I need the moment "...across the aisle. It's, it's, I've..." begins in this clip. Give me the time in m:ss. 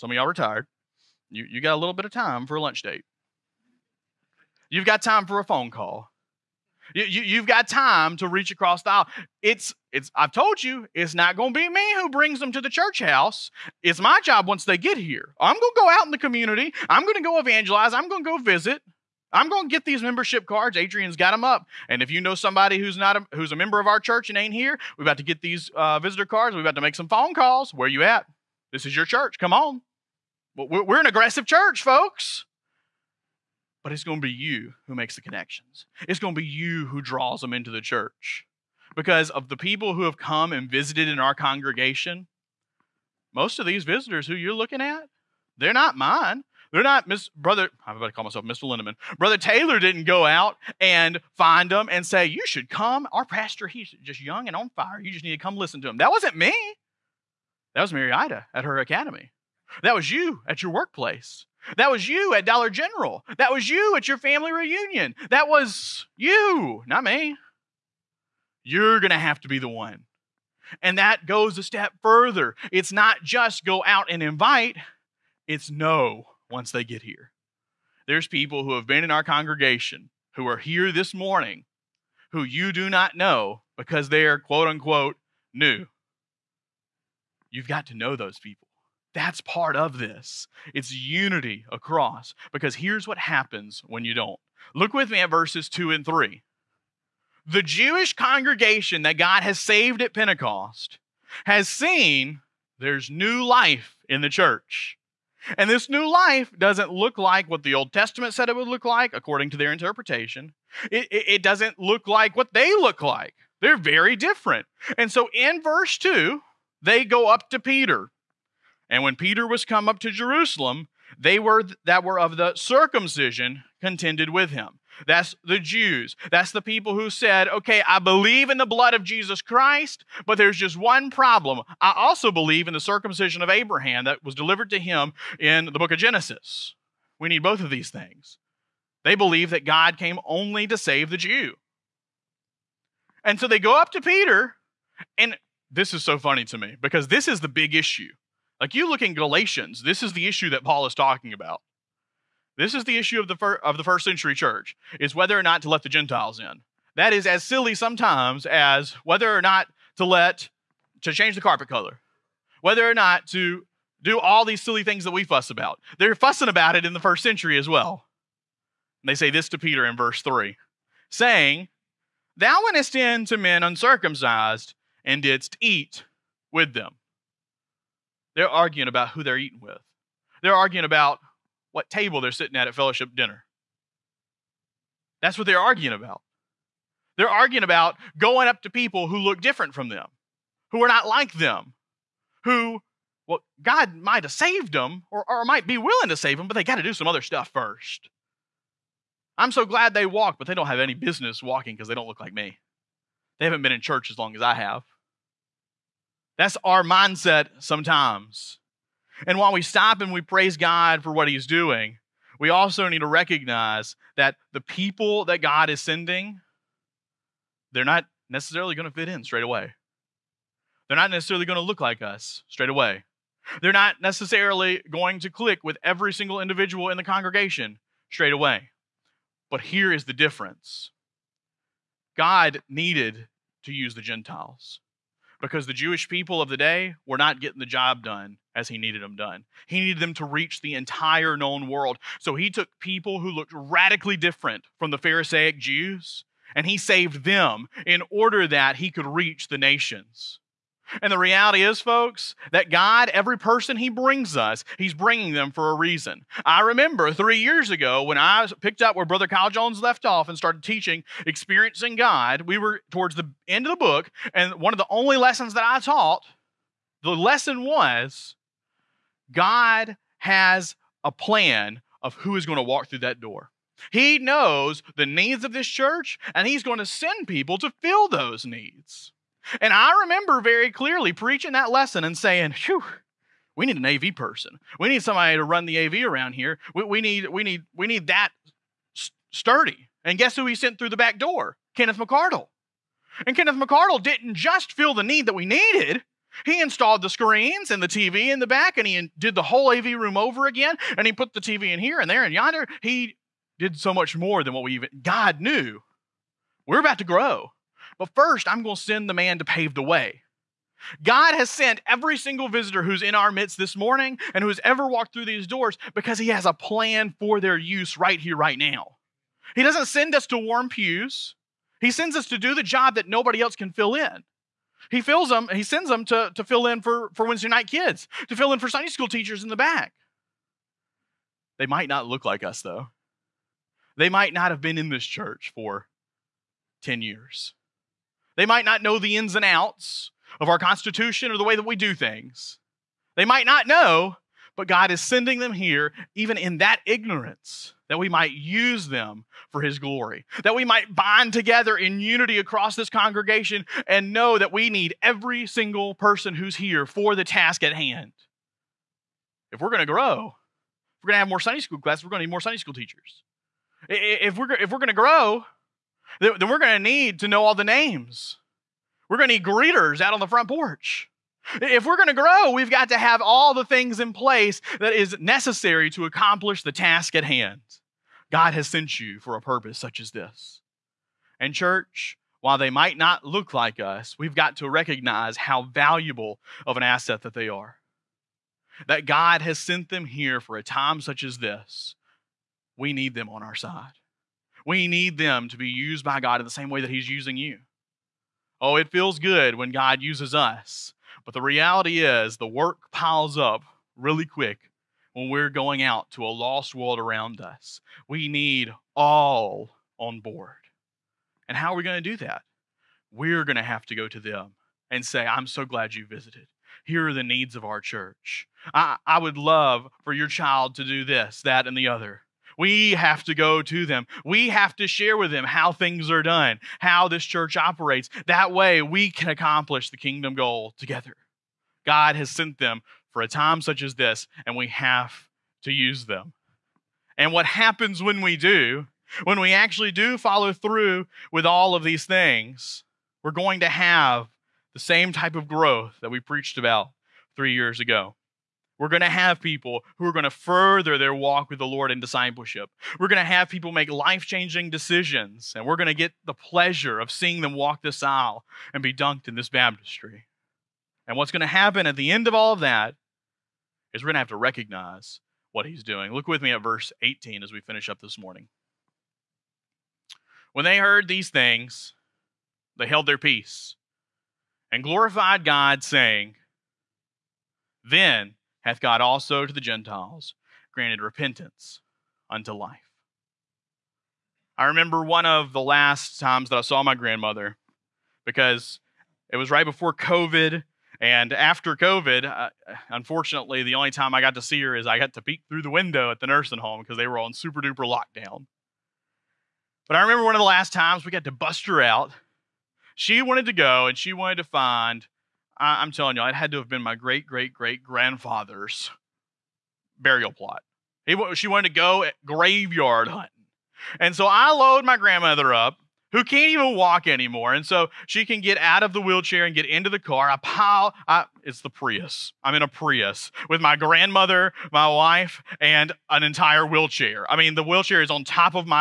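0:08.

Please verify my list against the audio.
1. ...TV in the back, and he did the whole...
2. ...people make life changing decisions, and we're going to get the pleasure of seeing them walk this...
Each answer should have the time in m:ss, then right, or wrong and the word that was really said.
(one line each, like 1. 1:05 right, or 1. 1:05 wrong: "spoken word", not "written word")
1. 4:57 right
2. 7:33 right.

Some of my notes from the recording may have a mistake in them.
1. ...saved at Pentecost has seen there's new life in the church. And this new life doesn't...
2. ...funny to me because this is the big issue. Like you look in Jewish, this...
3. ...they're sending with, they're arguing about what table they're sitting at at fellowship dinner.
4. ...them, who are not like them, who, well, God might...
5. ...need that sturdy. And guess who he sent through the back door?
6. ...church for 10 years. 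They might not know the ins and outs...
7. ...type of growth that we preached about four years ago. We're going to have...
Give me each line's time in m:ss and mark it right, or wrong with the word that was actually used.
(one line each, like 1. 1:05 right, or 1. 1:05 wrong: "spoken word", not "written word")
1. 1:39 right
2. 2:26 wrong: "Galatians", not "Jewish"
3. 2:59 wrong: "eating", not "sending"
4. 3:09 right
5. 4:47 right
6. 5:35 right
7. 7:25 wrong: "three", not "four".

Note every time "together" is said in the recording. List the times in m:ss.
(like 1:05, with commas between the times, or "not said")
5:51, 7:10.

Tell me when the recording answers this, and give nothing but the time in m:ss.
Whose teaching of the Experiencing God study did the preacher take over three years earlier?
4:19.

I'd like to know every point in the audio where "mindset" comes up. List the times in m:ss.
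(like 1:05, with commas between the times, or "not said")
3:26.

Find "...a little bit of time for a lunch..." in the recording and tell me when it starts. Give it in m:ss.
0:01.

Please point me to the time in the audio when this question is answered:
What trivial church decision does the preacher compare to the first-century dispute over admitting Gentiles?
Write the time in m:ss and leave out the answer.
2:41.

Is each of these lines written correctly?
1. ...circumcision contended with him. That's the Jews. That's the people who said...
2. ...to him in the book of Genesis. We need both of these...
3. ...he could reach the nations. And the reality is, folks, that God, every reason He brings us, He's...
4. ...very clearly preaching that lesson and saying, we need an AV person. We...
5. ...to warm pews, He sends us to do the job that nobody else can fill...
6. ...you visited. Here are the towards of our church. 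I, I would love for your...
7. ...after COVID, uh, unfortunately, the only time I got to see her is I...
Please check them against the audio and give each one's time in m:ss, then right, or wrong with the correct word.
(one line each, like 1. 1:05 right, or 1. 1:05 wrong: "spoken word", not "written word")
1. 2:02 right
2. 2:14 right
3. 4:08 wrong: "person", not "reason"
4. 4:40 right
5. 5:20 right
6. 6:55 wrong: "needs", not "towards"
7. 8:11 right.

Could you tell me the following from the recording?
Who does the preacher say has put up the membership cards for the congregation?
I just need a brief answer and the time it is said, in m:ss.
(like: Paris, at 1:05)
Adrian, at 0:20.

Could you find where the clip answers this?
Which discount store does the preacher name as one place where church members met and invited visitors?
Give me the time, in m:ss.
1:02.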